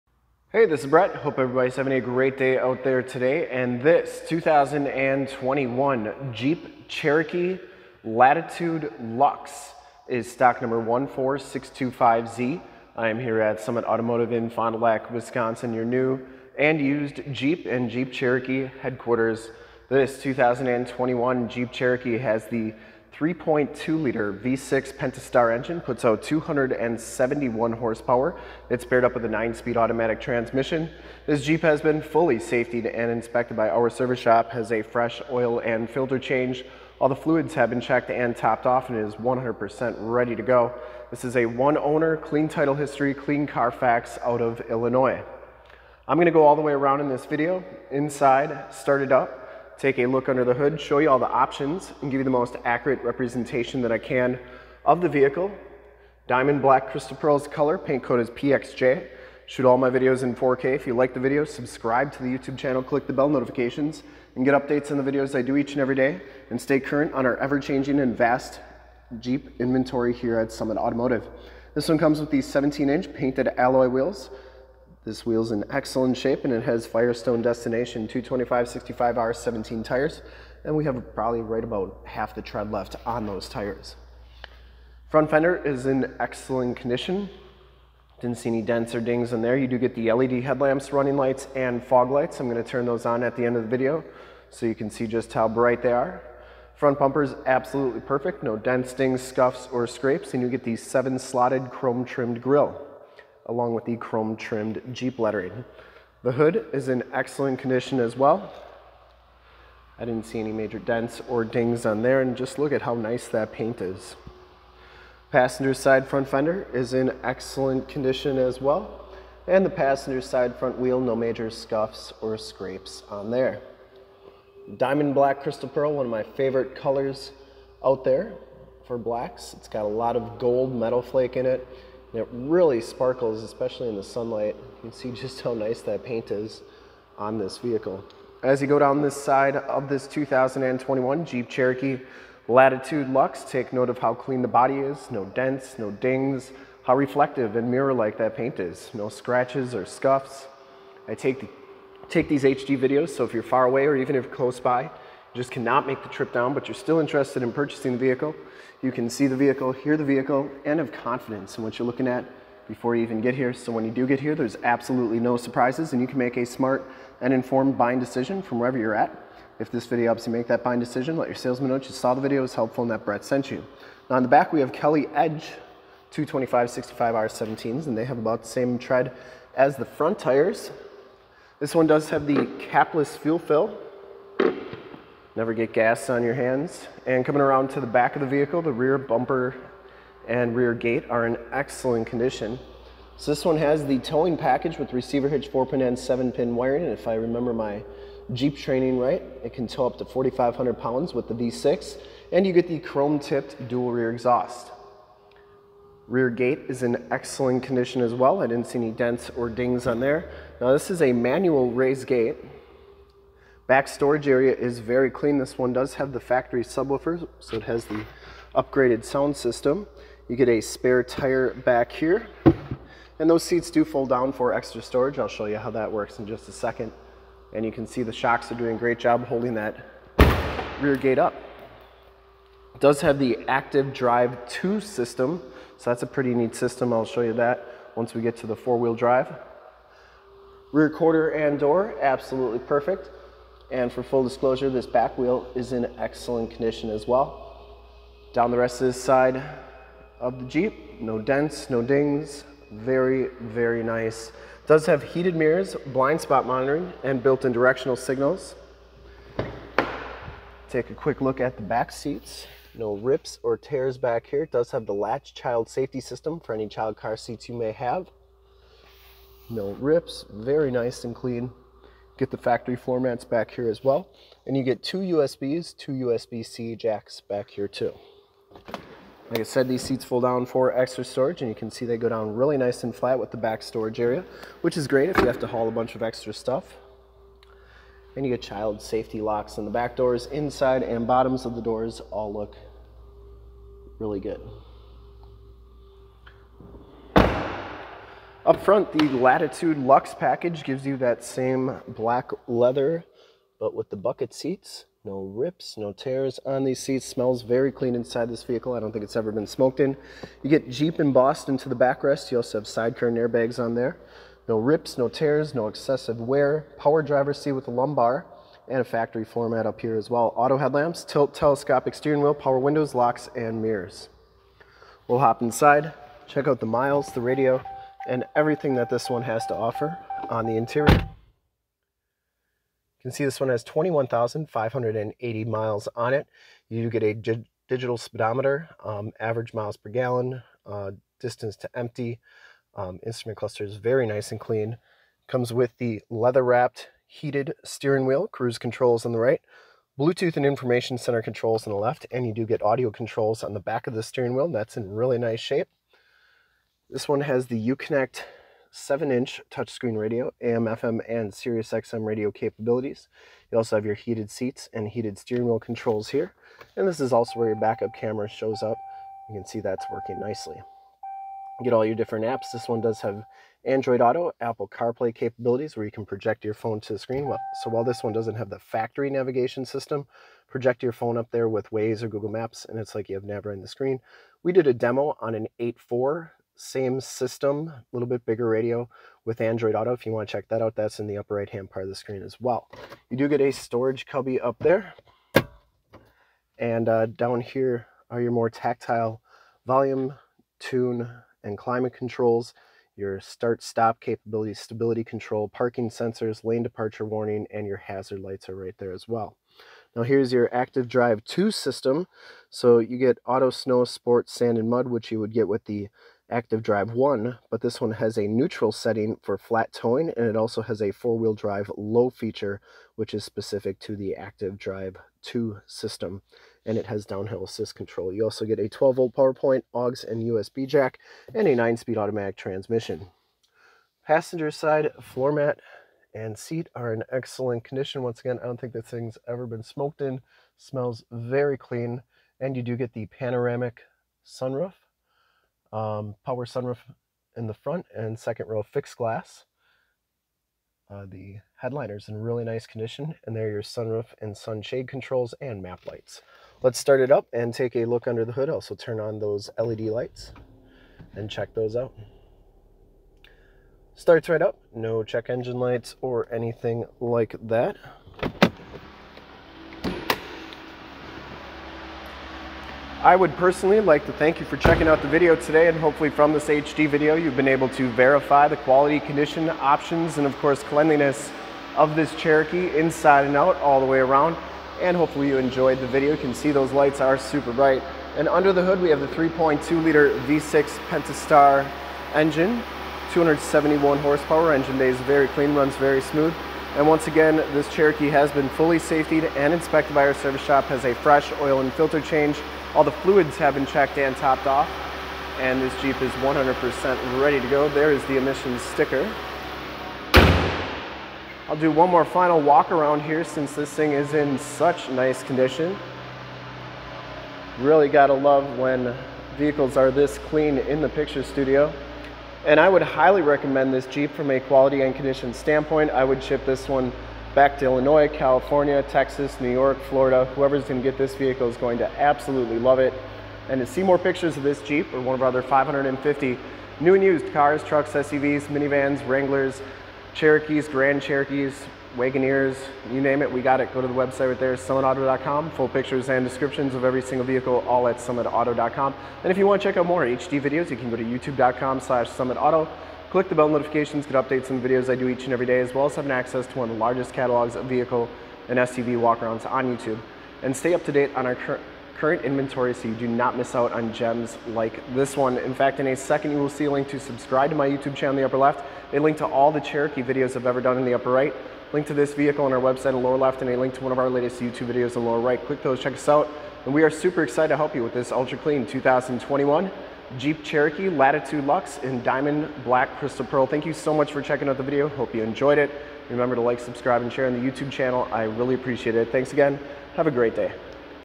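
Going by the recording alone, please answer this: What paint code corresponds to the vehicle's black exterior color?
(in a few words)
PXJ.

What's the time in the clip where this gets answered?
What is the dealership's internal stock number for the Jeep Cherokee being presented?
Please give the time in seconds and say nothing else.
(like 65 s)
10 s.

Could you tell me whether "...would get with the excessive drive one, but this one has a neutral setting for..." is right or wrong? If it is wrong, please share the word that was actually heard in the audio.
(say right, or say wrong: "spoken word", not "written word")
wrong: "active", not "excessive".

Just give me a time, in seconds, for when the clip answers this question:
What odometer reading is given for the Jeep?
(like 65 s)
333 s.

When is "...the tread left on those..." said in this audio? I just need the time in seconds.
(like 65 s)
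82 s.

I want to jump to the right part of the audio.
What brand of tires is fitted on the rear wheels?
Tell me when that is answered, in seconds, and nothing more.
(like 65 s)
174 s.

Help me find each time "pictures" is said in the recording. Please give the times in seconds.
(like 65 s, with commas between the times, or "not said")
520 s, 533 s, 545 s.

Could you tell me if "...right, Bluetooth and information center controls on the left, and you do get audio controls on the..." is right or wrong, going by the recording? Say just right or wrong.
right.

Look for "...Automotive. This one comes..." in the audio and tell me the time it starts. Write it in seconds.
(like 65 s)
70 s.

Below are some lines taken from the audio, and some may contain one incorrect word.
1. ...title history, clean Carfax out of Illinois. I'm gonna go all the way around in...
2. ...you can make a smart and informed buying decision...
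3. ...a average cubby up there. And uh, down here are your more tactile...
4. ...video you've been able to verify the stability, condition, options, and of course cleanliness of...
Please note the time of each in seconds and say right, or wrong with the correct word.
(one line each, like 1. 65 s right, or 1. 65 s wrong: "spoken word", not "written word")
1. 42 s right
2. 166 s right
3. 393 s wrong: "storage", not "average"
4. 476 s wrong: "quality", not "stability".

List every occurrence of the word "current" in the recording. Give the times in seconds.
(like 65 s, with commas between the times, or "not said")
66 s, 561 s.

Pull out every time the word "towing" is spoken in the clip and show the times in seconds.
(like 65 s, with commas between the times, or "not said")
193 s, 419 s.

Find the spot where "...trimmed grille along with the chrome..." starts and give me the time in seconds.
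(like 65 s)
102 s.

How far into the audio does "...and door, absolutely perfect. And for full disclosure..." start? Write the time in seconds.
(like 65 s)
241 s.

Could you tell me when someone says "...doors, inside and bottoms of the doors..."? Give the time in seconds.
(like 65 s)
289 s.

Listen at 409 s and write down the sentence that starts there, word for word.
Now here's your active drive 2 system.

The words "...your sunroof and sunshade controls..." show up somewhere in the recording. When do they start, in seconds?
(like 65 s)
453 s.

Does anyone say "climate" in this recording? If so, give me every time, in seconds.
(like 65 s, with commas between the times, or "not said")
401 s.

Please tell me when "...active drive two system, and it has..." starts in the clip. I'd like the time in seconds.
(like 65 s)
424 s.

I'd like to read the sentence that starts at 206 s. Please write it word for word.
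Rear gate is in excellent condition as well.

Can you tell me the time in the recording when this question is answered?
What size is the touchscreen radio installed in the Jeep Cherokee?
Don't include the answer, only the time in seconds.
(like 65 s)
358 s.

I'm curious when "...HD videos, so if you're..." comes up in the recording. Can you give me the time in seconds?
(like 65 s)
152 s.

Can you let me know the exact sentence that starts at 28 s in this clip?
It's paired up with a 9-speed automatic transmission.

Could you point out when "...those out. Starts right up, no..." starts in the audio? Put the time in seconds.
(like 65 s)
461 s.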